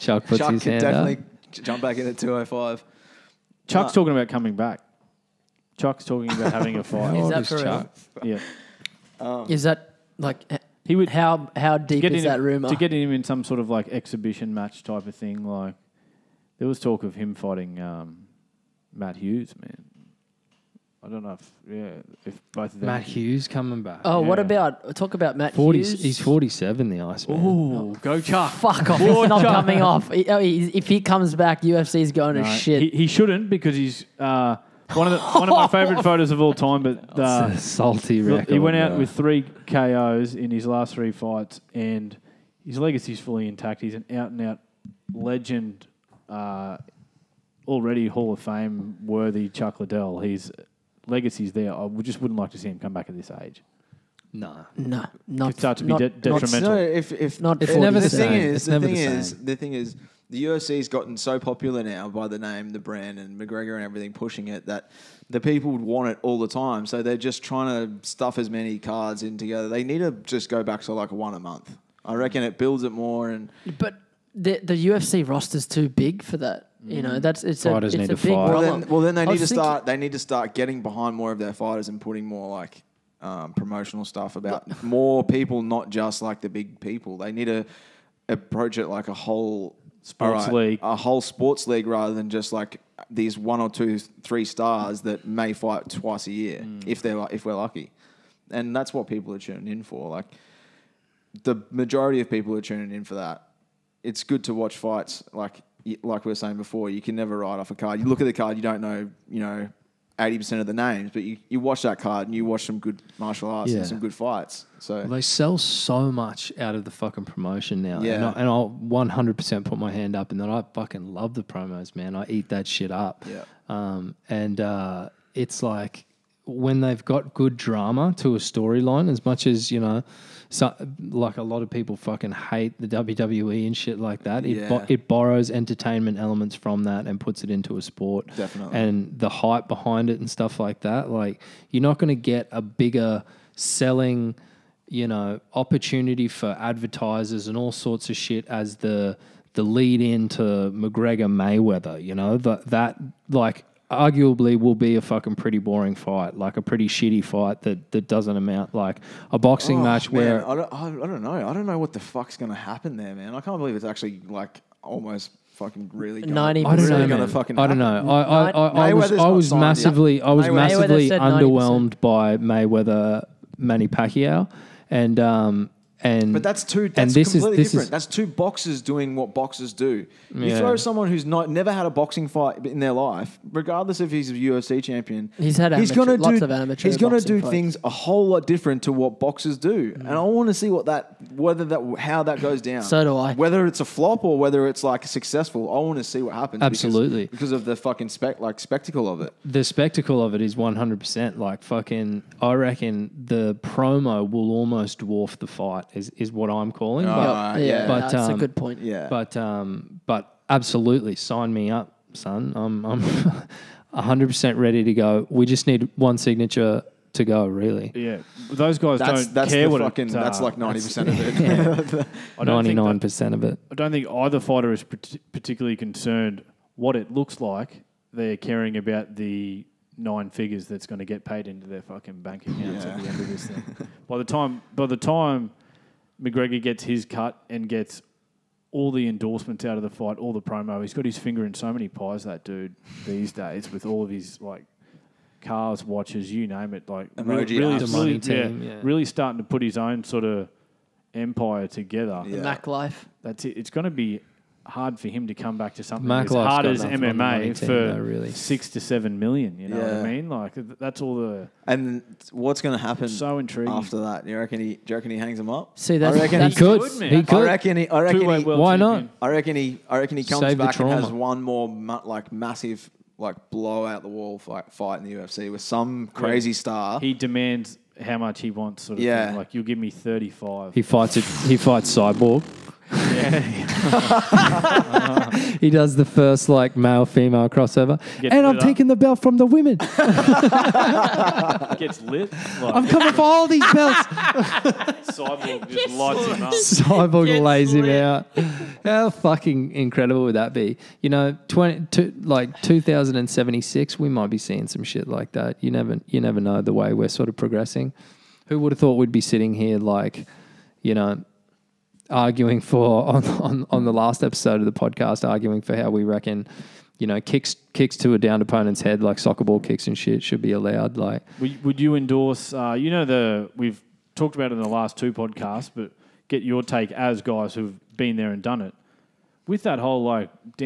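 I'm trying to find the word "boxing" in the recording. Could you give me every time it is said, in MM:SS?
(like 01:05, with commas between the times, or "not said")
02:39, 03:01.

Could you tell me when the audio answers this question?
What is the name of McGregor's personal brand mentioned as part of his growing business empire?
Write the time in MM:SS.
04:12.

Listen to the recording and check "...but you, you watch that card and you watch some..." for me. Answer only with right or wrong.
right.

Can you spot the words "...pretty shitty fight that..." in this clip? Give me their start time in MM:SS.
02:36.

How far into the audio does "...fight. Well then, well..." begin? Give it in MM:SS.
01:18.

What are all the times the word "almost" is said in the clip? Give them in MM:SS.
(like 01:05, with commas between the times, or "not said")
02:44, 03:24.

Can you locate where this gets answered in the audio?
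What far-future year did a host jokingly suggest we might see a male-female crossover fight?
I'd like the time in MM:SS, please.
05:02.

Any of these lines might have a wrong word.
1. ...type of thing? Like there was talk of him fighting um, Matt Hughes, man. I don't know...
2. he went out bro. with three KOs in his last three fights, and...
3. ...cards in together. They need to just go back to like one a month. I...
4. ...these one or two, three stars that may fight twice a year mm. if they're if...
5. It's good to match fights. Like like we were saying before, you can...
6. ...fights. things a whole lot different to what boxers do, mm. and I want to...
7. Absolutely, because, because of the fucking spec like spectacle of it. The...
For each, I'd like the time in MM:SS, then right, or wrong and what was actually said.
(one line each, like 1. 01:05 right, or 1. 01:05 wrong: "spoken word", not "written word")
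1. 00:14 right
2. 00:38 right
3. 01:08 right
4. 01:33 right
5. 01:44 wrong: "watch", not "match"
6. 03:07 right
7. 03:16 right.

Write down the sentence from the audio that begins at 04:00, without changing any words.
He's got his finger in so many pies, that dude, these days, with all of his like cars, watches, you name it.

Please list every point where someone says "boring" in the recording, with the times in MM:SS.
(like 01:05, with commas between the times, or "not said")
02:35.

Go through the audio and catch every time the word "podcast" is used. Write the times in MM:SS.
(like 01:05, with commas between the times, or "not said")
05:14, 05:25.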